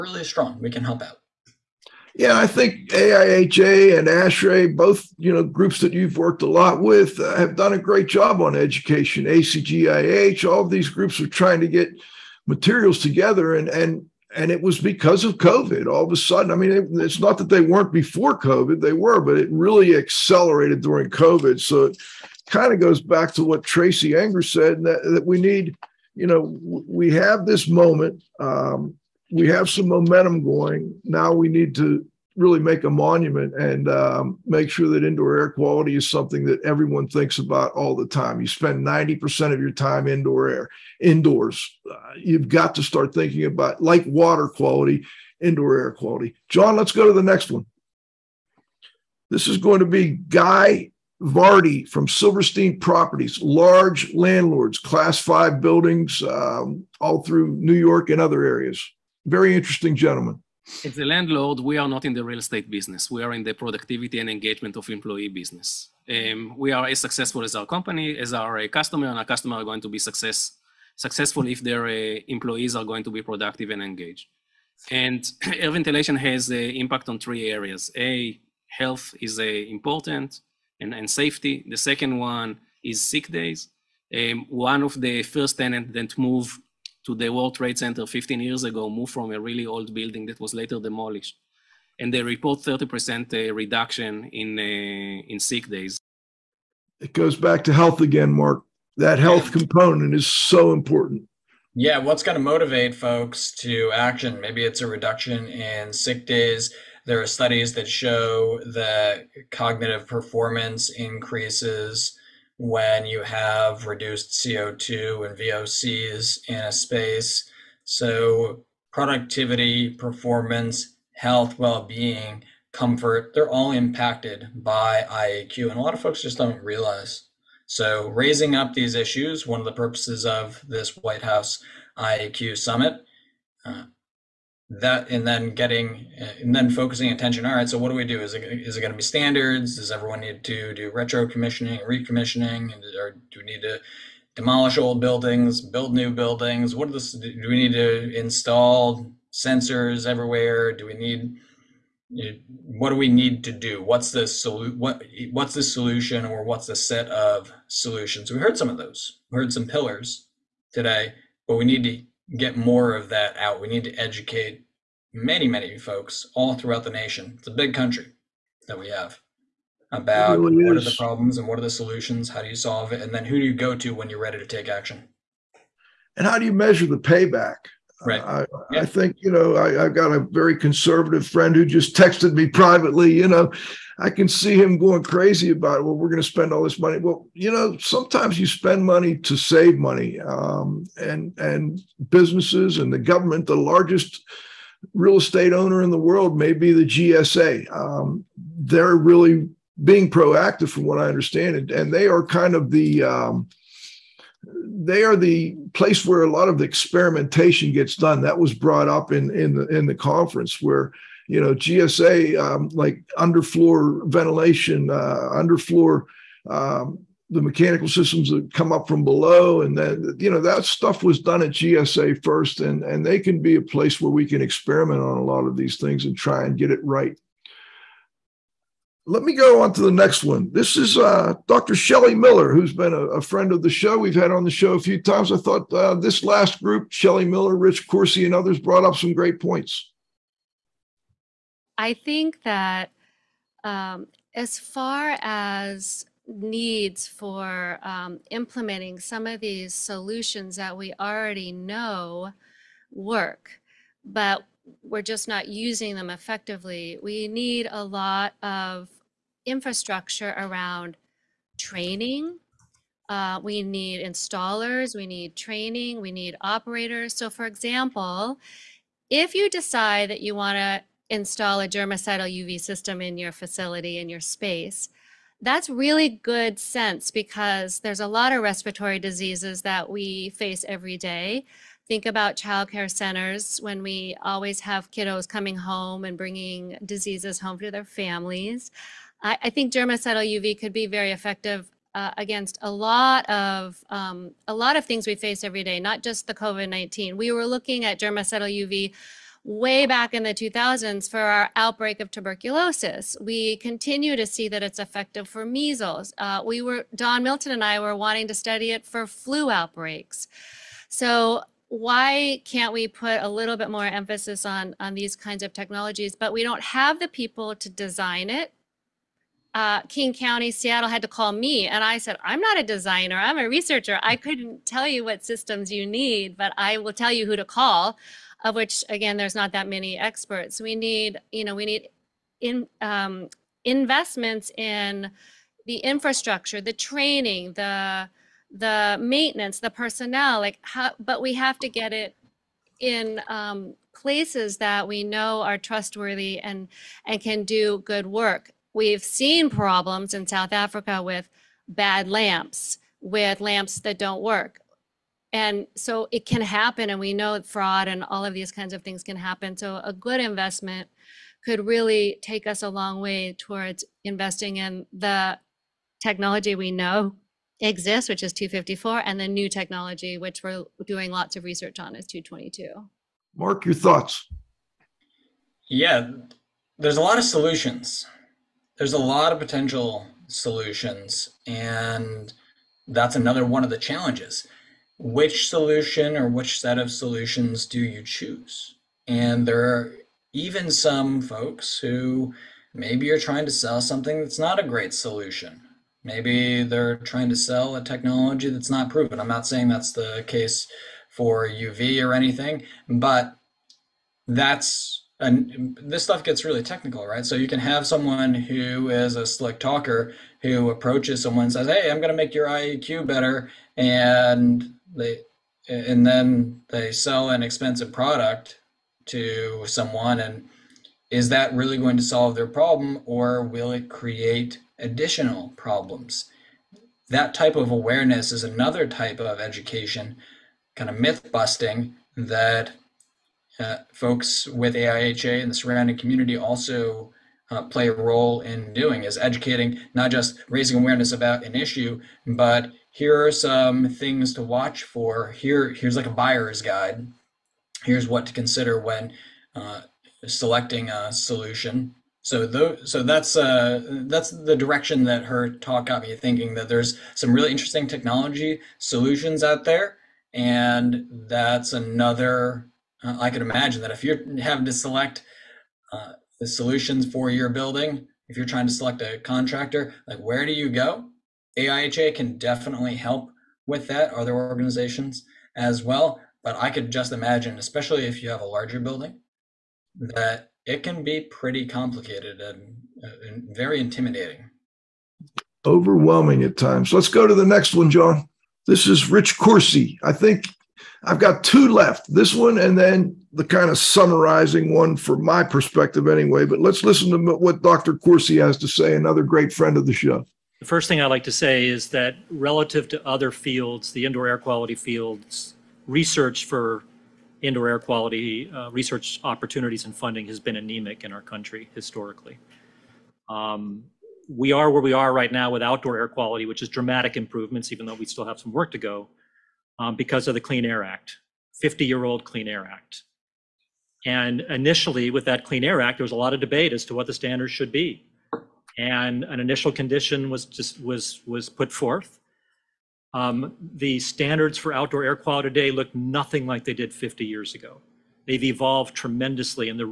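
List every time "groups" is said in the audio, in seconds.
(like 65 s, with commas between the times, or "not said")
5 s, 10 s, 236 s.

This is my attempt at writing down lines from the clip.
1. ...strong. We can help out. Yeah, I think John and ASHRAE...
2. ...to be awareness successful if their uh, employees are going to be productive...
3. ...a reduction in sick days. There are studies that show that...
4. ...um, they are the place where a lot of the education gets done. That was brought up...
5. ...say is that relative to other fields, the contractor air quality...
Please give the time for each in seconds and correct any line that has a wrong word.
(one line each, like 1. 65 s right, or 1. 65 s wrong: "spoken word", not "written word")
1. 0 s wrong: "AIHA", not "John"
2. 69 s wrong: "success", not "awareness"
3. 104 s right
4. 203 s wrong: "experimentation", not "education"
5. 501 s wrong: "indoor", not "contractor".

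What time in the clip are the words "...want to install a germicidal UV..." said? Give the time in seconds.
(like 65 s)
270 s.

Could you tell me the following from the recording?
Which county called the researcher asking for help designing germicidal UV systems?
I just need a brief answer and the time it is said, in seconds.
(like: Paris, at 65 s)
King County, at 319 s.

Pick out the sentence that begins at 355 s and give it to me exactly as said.
And so it can happen, and we know fraud and all of these kinds of things can happen.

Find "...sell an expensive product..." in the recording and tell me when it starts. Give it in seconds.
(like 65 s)
416 s.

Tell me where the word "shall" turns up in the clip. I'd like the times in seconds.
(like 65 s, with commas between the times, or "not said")
not said.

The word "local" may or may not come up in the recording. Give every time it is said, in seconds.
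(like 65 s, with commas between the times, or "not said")
not said.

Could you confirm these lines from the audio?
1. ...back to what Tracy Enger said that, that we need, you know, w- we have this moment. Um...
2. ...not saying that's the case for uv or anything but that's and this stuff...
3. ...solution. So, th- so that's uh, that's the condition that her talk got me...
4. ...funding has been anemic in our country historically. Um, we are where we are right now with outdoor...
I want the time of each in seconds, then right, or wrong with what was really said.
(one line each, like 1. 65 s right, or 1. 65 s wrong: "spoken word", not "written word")
1. 23 s right
2. 399 s right
3. 451 s wrong: "direction", not "condition"
4. 509 s right.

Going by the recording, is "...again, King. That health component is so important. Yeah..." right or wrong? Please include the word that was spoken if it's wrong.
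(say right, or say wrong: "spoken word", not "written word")
wrong: "Mark", not "King".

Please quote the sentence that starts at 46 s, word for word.
John, let's go to the next one.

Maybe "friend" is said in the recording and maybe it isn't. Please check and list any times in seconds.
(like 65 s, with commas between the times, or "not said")
181 s, 233 s, 499 s.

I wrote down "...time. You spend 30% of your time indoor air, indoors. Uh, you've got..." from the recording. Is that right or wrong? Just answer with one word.
wrong.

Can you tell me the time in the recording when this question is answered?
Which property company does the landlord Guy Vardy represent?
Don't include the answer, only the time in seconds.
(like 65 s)
52 s.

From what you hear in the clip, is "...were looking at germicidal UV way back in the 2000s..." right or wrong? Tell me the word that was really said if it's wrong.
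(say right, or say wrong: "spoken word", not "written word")
right.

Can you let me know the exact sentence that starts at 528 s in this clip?
And an initial condition was just was was put forth.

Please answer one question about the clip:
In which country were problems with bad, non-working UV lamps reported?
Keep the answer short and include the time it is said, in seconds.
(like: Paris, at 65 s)
South Africa, at 350 s.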